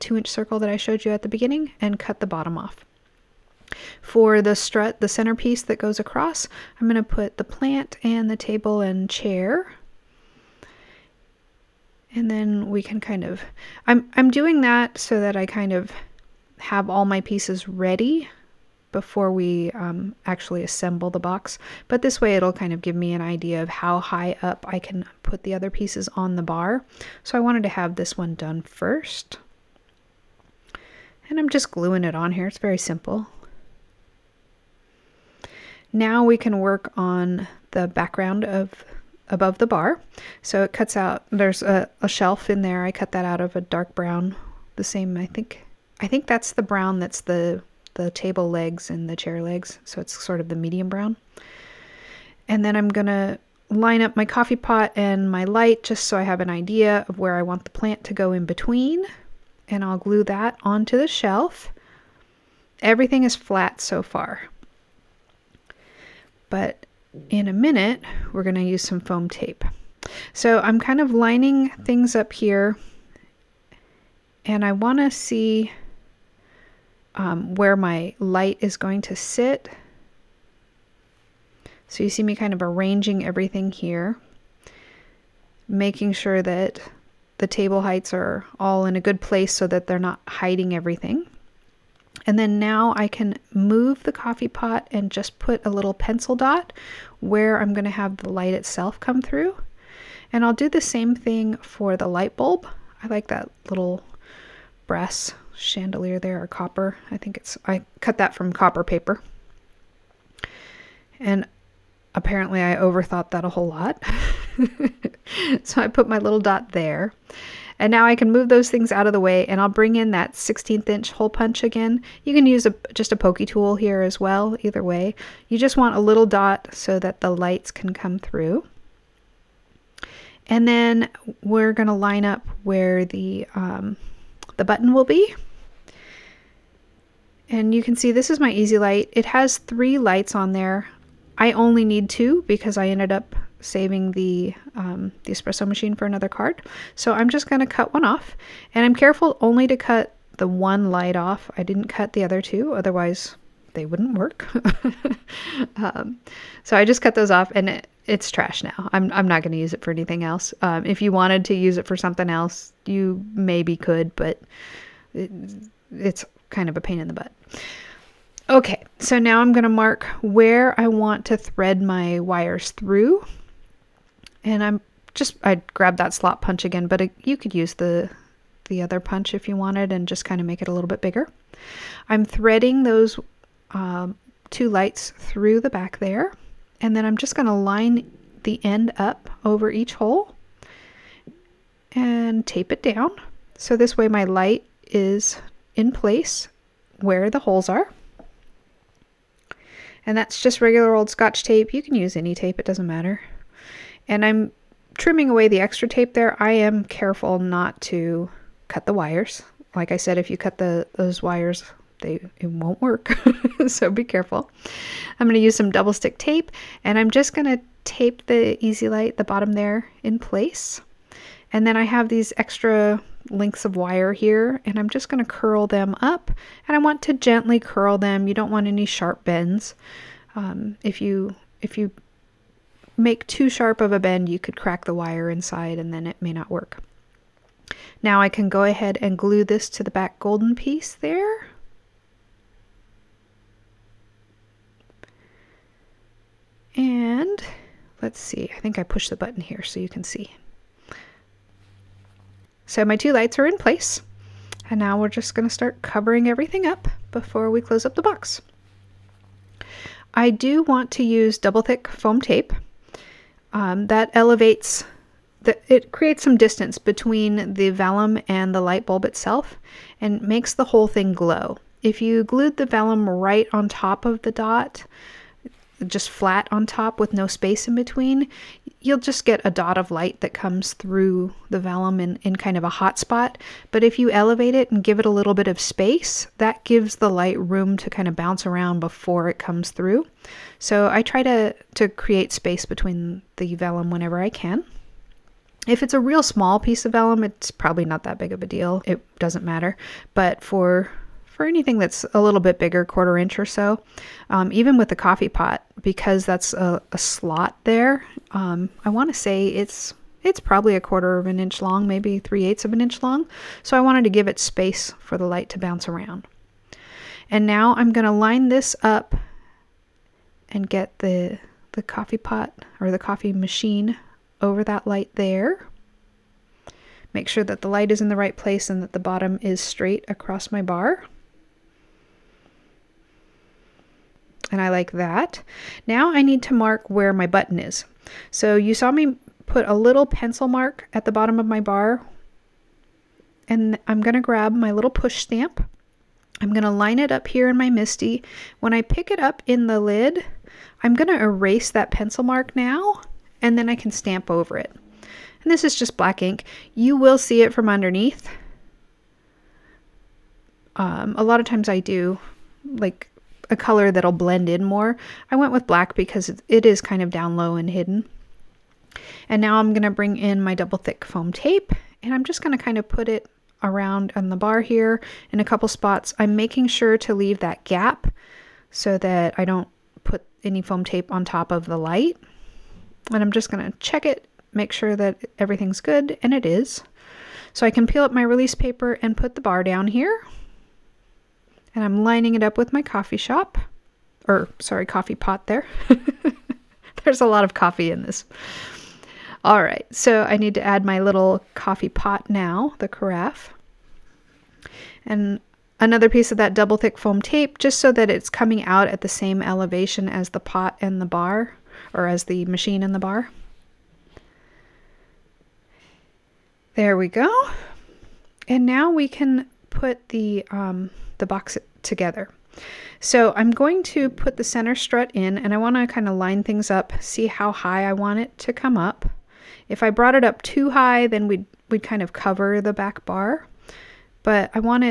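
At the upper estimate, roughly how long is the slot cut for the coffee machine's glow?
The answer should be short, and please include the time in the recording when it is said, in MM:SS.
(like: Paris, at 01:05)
3/8 inch, at 05:12.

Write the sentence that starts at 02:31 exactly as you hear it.
I didn't cut the other two, otherwise they wouldn't work.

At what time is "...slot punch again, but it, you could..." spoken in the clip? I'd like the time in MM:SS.
02:56.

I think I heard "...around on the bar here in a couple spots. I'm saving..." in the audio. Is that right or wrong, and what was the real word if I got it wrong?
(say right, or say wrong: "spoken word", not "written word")
wrong: "making", not "saving".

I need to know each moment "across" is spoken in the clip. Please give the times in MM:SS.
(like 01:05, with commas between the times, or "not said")
00:05, 05:30.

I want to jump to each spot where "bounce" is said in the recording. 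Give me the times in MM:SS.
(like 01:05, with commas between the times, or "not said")
04:48, 05:15.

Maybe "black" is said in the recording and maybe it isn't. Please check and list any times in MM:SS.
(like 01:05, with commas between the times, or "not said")
05:55, 06:05.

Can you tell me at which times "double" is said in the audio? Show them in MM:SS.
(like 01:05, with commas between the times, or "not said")
03:35, 04:21, 06:10, 06:46.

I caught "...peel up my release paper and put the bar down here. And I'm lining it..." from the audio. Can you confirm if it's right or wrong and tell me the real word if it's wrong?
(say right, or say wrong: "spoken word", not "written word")
right.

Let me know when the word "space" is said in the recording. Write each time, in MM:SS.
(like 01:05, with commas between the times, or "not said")
04:37, 04:45, 04:52, 05:14.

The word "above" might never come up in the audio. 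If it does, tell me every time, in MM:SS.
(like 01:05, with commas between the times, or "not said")
00:39.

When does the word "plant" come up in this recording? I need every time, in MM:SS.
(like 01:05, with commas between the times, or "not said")
00:07, 00:57.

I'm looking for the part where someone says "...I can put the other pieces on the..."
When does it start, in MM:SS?
00:24.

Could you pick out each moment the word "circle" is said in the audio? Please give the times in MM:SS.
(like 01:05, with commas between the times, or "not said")
00:00.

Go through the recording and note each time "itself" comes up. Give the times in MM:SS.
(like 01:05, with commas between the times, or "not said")
01:38, 04:29.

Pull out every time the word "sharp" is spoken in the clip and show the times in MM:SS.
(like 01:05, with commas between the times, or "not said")
03:48, 03:53.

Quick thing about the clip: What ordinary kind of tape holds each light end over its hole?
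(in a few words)
scotch tape.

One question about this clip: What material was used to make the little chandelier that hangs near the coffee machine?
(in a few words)
copper paper.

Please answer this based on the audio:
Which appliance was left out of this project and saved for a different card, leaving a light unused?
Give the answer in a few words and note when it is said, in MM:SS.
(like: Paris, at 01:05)
espresso machine, at 02:25.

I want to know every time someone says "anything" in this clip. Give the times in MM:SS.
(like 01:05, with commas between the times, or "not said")
02:39, 05:01.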